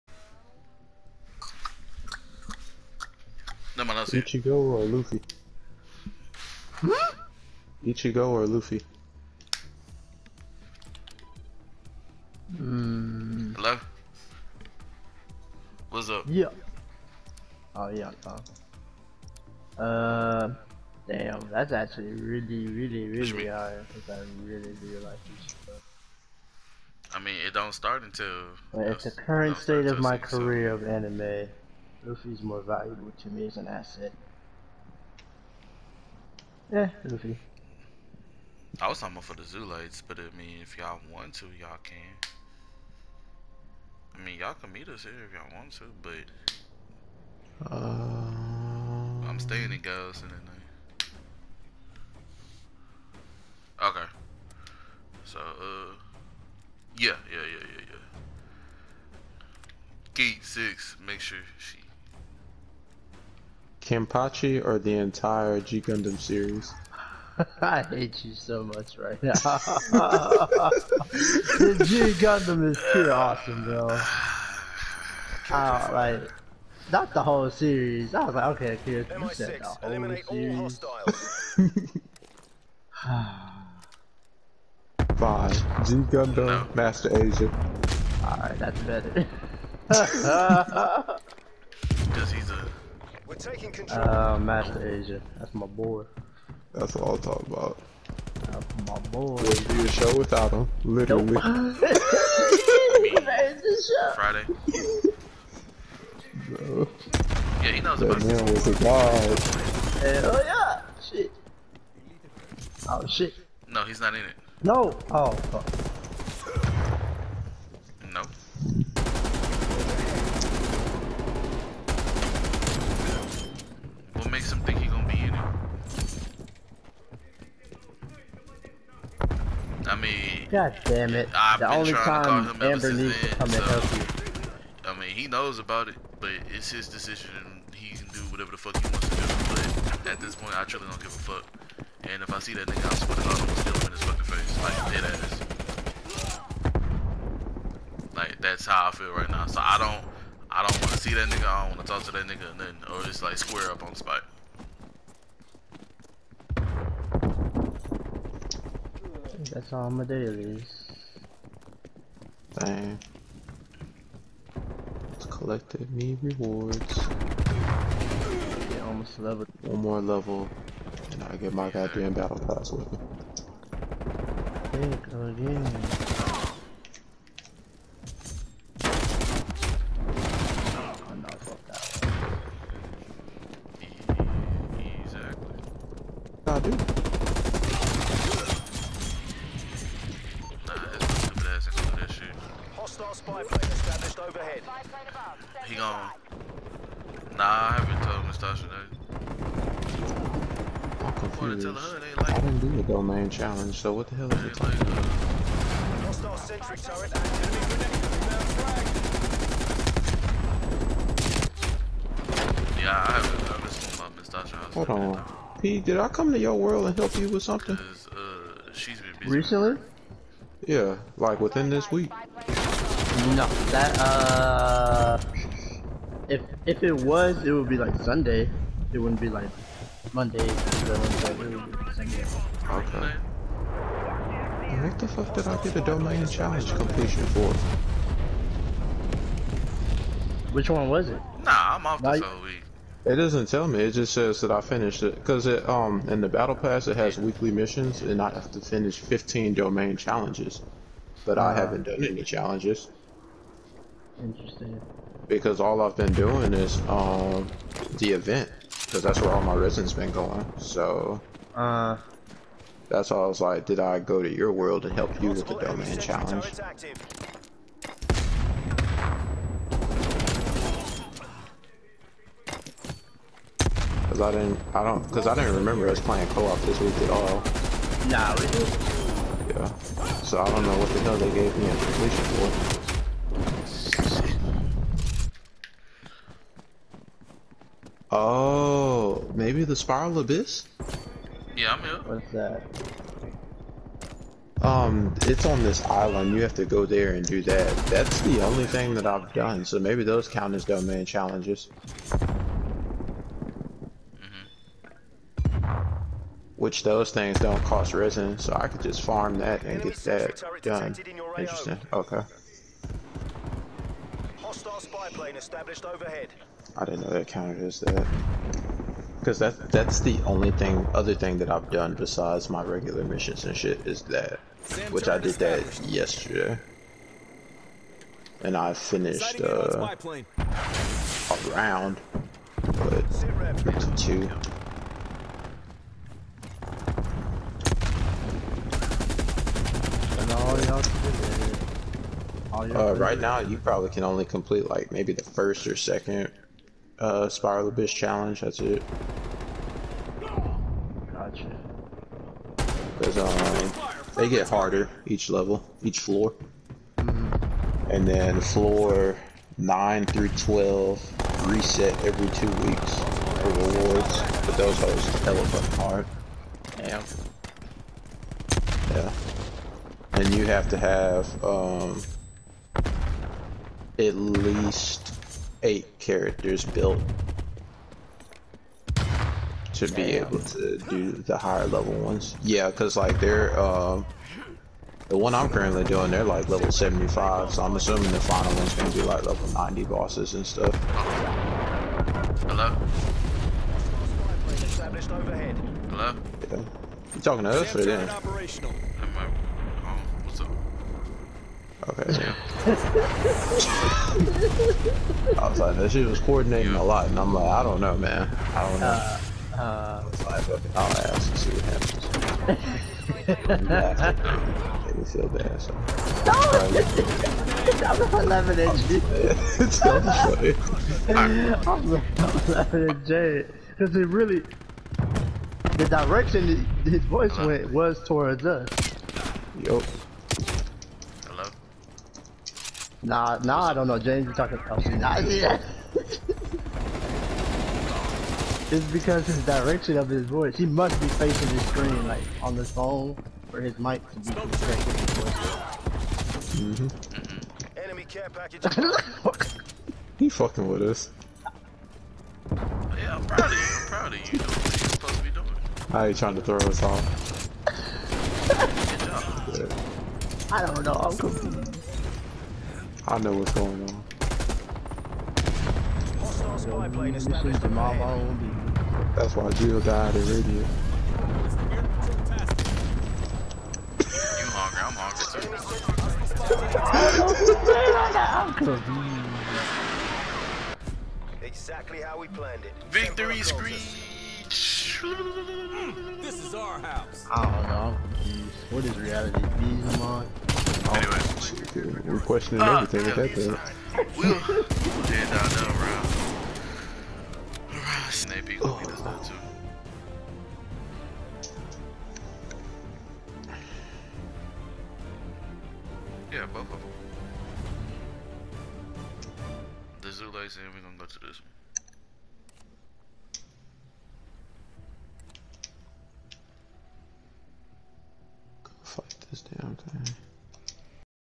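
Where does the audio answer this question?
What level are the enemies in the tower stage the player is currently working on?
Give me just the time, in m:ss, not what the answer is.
6:26.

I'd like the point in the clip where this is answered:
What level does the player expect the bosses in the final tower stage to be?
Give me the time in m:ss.
6:29.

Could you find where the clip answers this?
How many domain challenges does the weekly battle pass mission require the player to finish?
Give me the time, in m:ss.
4:08.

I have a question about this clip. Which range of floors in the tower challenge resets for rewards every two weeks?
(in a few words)
9 through 12.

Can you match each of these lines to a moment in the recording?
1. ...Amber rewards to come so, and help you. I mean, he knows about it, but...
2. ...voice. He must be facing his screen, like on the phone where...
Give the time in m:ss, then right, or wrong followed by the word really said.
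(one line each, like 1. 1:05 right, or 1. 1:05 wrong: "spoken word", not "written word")
1. 2:12 wrong: "needs", not "rewards"
2. 7:20 right.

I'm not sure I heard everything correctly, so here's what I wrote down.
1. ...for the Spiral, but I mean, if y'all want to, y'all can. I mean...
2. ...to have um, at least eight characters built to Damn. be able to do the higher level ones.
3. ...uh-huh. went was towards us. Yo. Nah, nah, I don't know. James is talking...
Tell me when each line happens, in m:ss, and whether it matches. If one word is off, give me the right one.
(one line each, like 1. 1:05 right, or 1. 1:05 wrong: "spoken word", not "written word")
1. 0:39 wrong: "Zoolites", not "Spiral"
2. 6:10 right
3. 7:07 right.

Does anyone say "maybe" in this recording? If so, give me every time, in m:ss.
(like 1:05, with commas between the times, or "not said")
4:49, 4:59, 5:44.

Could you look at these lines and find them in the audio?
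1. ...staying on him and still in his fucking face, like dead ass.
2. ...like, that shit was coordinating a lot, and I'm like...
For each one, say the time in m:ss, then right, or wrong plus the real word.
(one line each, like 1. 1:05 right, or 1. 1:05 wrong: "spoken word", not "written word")
1. 2:22 wrong: "sweating", not "staying"
2. 6:45 right.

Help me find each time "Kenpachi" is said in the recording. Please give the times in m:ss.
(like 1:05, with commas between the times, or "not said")
1:03.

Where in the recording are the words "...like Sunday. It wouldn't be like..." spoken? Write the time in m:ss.
3:47.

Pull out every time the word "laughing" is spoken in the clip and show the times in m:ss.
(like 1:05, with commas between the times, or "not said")
6:58, 7:02.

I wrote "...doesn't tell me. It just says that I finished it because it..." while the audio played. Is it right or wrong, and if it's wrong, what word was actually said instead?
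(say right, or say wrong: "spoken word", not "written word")
right.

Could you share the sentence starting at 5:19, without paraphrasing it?
Because that, that's the only thing, other thing that I've done besides my regular missions and shit is that.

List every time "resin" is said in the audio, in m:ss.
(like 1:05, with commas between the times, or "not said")
4:19, 5:07.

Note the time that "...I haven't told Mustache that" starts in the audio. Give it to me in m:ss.
3:17.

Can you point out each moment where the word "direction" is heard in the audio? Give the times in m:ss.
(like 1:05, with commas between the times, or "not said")
7:05, 7:19.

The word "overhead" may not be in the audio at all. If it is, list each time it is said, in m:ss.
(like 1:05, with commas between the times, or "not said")
5:15.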